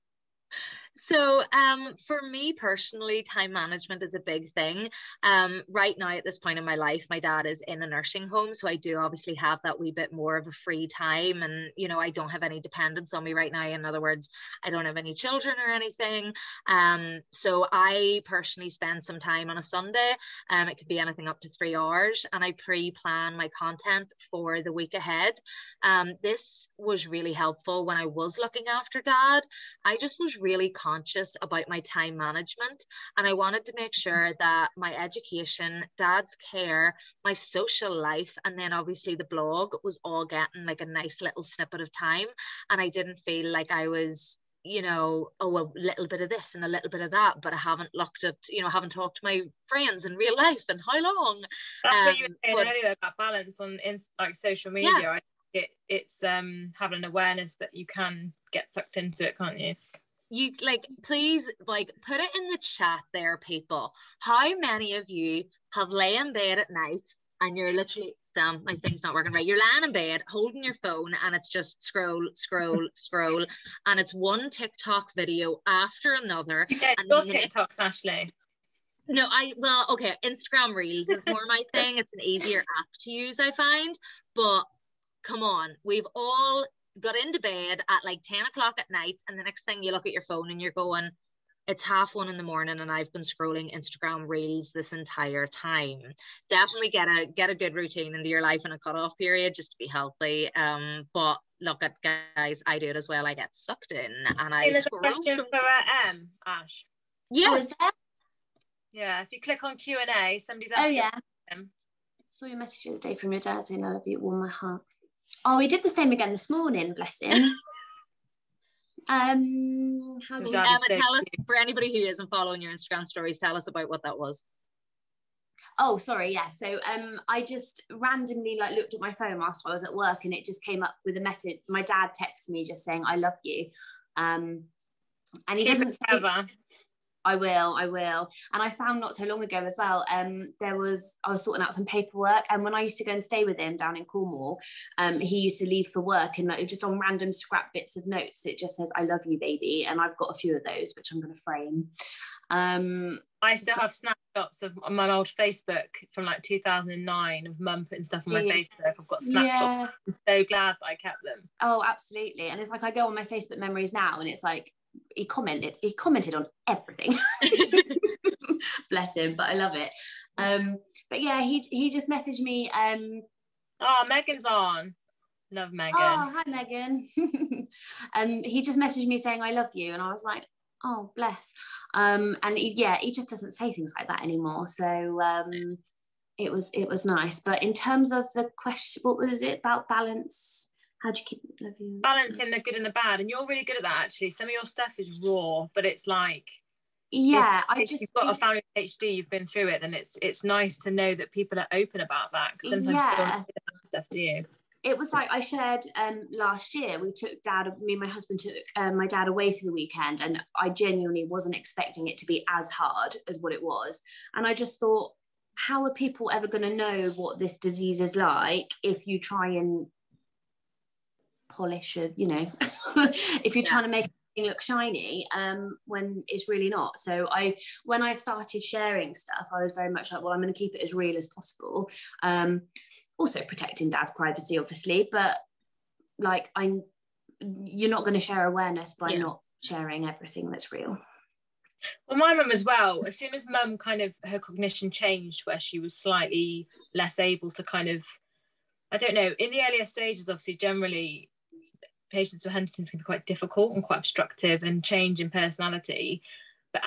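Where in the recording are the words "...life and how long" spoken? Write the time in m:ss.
0:50.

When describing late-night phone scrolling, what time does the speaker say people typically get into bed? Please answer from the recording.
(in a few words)
10 o'clock.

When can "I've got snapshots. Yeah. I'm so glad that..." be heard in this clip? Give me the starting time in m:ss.
2:39.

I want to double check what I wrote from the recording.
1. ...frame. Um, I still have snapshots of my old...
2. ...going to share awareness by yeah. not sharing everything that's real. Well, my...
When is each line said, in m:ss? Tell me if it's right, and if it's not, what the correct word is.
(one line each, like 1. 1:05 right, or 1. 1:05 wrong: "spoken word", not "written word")
1. 2:31 right
2. 3:58 right.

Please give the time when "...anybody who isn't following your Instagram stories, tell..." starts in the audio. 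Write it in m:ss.
2:01.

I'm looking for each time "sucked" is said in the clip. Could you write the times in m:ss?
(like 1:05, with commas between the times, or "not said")
0:58, 1:43.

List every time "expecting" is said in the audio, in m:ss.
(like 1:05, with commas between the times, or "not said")
3:31.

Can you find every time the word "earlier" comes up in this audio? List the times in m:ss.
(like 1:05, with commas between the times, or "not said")
0:52, 4:09.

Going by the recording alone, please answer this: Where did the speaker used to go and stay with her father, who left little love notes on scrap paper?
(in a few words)
Cornwall.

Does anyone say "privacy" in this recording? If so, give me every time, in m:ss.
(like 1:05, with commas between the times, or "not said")
3:54.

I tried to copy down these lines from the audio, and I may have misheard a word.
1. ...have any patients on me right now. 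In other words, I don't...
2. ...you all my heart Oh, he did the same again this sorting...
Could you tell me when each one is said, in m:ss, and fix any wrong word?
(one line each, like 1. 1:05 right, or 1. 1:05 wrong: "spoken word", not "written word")
1. 0:12 wrong: "dependents", not "patients"
2. 1:54 wrong: "morning", not "sorting".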